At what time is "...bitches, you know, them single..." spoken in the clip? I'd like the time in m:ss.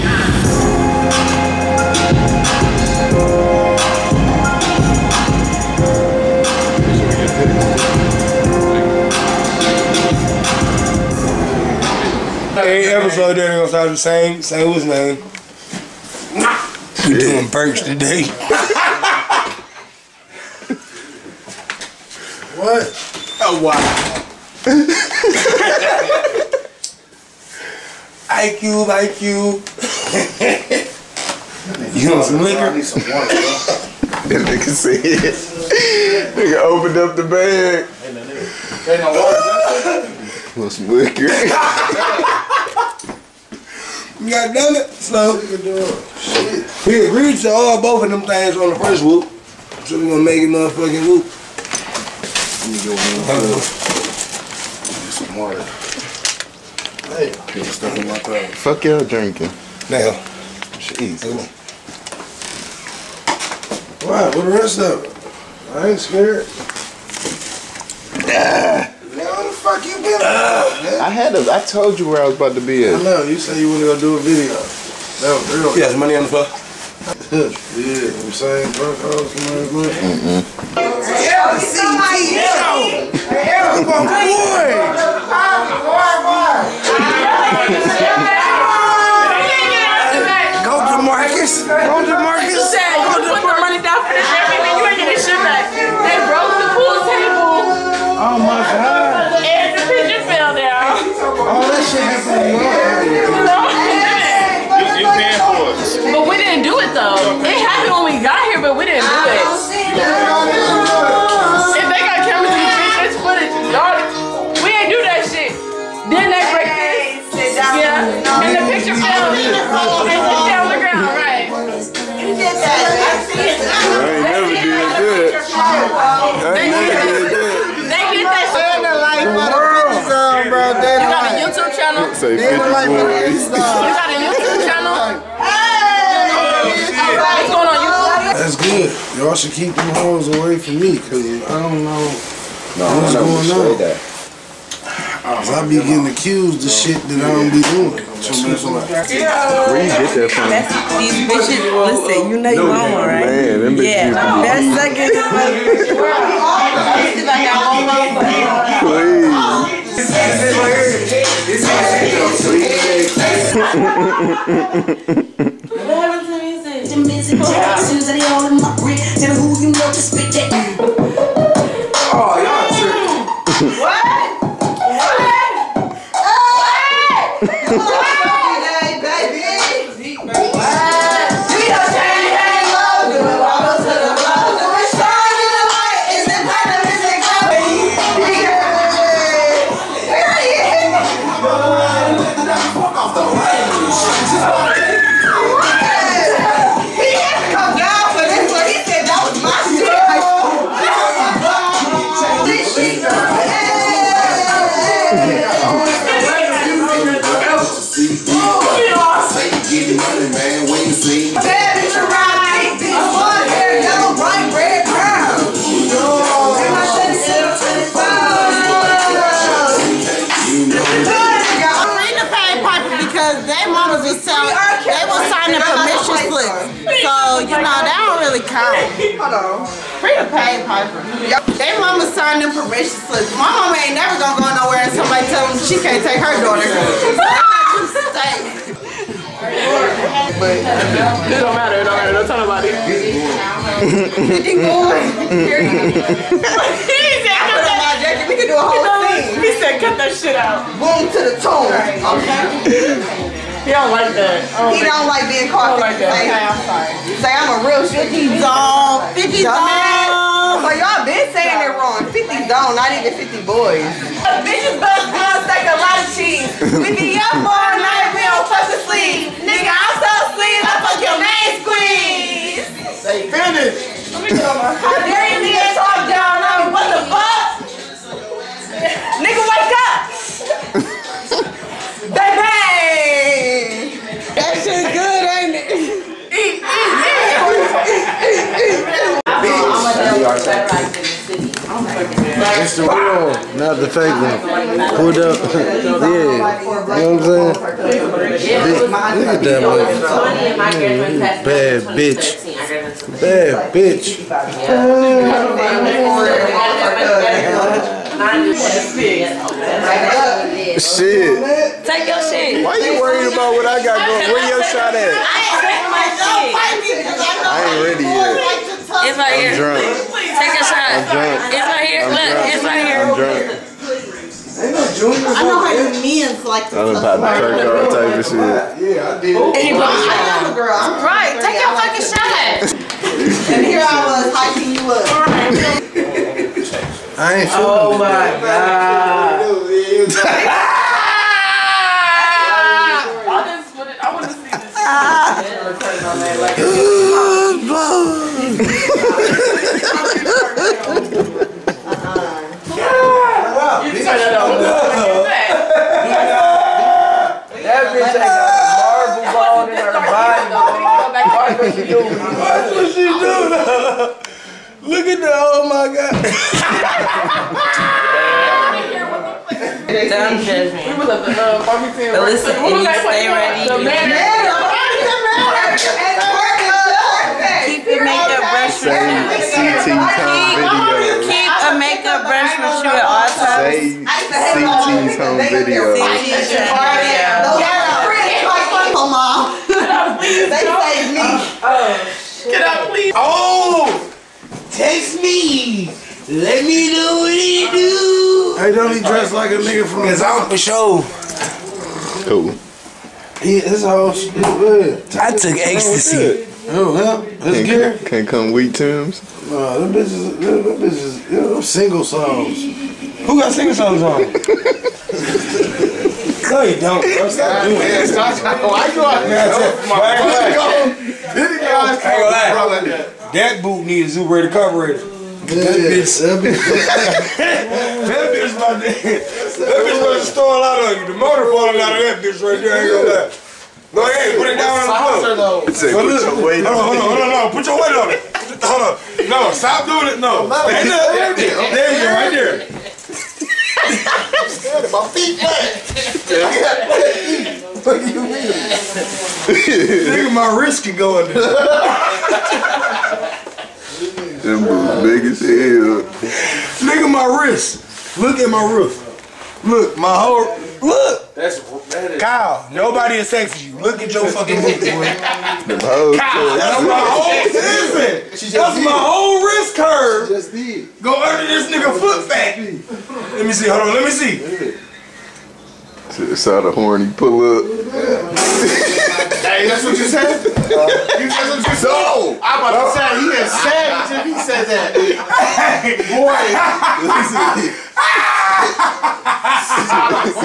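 6:50.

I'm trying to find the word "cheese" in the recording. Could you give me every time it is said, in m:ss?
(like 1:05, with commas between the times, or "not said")
4:26.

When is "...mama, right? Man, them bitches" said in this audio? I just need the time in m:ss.
2:32.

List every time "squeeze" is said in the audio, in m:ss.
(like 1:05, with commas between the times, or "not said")
4:31.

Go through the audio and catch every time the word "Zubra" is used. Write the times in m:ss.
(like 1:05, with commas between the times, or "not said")
7:04.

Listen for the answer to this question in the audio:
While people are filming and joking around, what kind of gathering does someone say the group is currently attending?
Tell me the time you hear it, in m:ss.
6:11.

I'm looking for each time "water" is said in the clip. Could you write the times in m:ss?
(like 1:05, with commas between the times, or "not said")
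0:33, 0:40, 0:55.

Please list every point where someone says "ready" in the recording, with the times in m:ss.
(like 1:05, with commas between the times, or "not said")
5:17, 6:13.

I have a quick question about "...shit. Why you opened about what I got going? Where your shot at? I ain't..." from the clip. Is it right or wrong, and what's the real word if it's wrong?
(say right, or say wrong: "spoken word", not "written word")
wrong: "worried", not "opened".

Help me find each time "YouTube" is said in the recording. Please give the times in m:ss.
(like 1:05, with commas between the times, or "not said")
2:12, 2:17.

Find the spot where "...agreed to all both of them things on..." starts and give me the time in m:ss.
0:47.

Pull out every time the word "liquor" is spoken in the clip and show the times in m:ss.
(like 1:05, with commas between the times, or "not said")
0:32, 0:40.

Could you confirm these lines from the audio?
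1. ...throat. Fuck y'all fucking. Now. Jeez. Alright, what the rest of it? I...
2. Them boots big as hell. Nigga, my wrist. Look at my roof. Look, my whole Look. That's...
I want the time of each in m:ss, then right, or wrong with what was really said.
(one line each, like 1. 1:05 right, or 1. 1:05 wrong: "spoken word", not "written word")
1. 0:58 wrong: "drinking", not "fucking"
2. 7:34 right.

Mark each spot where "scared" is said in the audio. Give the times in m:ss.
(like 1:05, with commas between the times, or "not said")
1:05, 7:24.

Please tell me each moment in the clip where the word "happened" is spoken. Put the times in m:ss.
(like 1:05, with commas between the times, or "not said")
1:47.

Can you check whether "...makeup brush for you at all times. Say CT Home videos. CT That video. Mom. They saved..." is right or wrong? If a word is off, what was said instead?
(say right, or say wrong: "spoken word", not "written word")
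wrong: "Home", not "That".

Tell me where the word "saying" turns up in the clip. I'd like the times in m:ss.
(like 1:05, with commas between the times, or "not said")
1:18, 4:21, 4:57.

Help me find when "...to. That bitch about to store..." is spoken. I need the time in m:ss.
7:08.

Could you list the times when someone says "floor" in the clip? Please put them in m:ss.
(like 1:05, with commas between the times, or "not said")
1:16, 7:15.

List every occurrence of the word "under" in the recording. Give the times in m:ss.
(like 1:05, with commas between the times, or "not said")
7:51.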